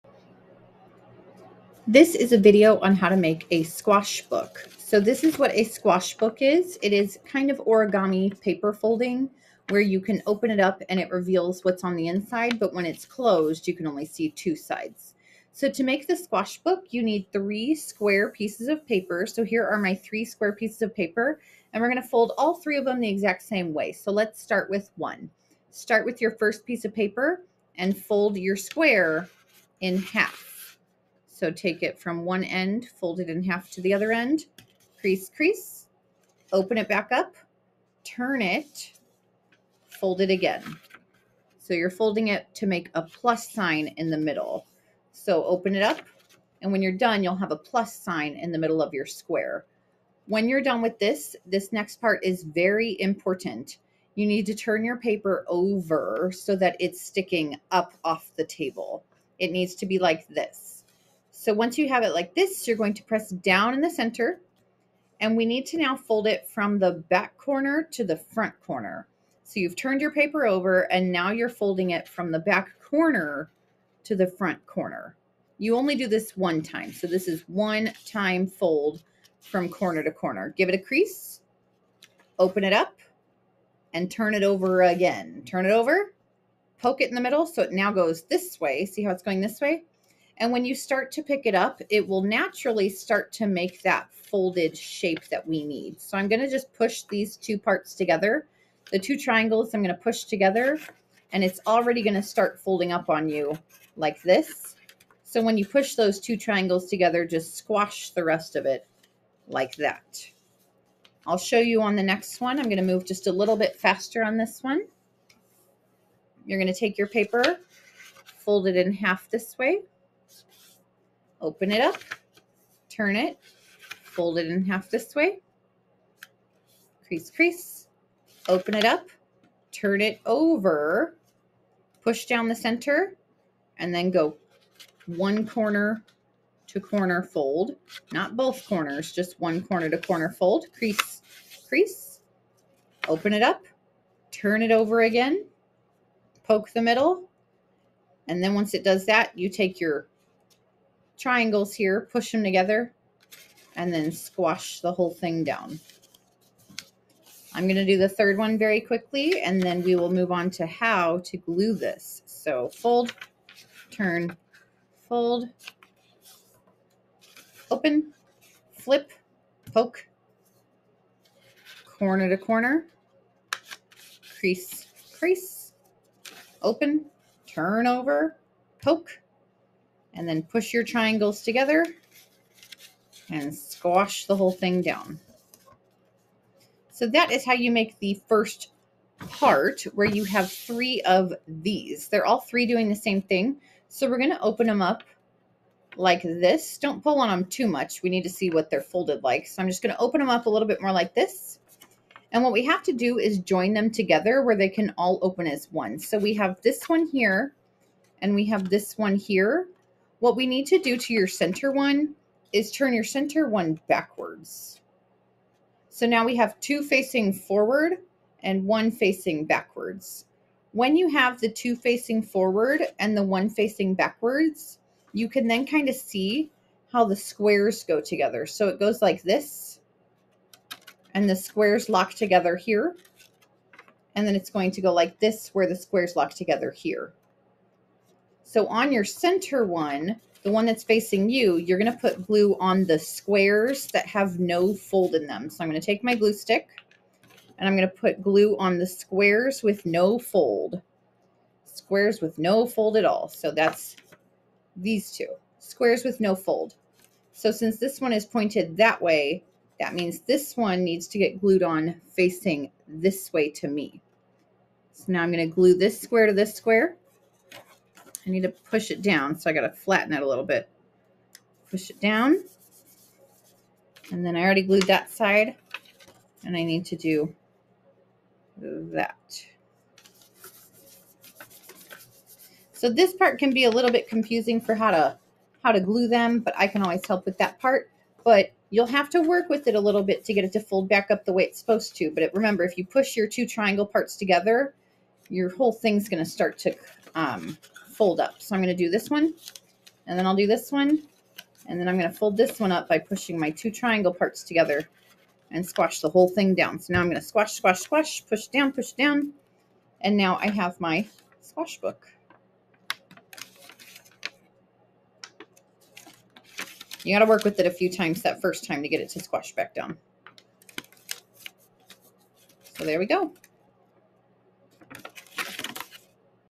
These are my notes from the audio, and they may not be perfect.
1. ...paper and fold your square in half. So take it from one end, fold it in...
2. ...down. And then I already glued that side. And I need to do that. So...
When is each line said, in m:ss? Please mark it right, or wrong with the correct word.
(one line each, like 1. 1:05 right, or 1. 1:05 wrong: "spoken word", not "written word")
1. 0:26 right
2. 4:31 right.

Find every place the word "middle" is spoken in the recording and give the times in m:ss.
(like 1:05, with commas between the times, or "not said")
0:44, 0:48, 1:27, 2:26.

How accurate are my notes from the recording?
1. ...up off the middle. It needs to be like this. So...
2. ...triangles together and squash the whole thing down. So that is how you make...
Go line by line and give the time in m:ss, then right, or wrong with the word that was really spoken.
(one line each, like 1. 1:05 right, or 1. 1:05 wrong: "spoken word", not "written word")
1. 0:57 wrong: "table", not "middle"
2. 3:00 right.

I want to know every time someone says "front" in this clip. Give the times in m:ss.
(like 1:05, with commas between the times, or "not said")
1:08, 1:14.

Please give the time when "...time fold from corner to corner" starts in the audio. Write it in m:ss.
1:18.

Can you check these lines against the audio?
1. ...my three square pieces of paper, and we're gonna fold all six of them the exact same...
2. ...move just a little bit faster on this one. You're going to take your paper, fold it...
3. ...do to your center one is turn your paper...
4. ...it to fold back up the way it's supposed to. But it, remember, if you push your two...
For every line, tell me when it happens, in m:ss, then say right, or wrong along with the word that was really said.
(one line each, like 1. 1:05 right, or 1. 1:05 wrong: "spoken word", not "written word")
1. 0:19 wrong: "three", not "six"
2. 1:52 right
3. 3:30 wrong: "center", not "paper"
4. 4:50 right.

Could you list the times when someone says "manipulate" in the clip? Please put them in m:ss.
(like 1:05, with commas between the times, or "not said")
not said.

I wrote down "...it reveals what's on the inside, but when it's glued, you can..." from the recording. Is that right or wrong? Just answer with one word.
wrong.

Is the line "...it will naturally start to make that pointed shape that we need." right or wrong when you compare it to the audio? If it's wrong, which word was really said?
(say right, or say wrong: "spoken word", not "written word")
wrong: "folded", not "pointed".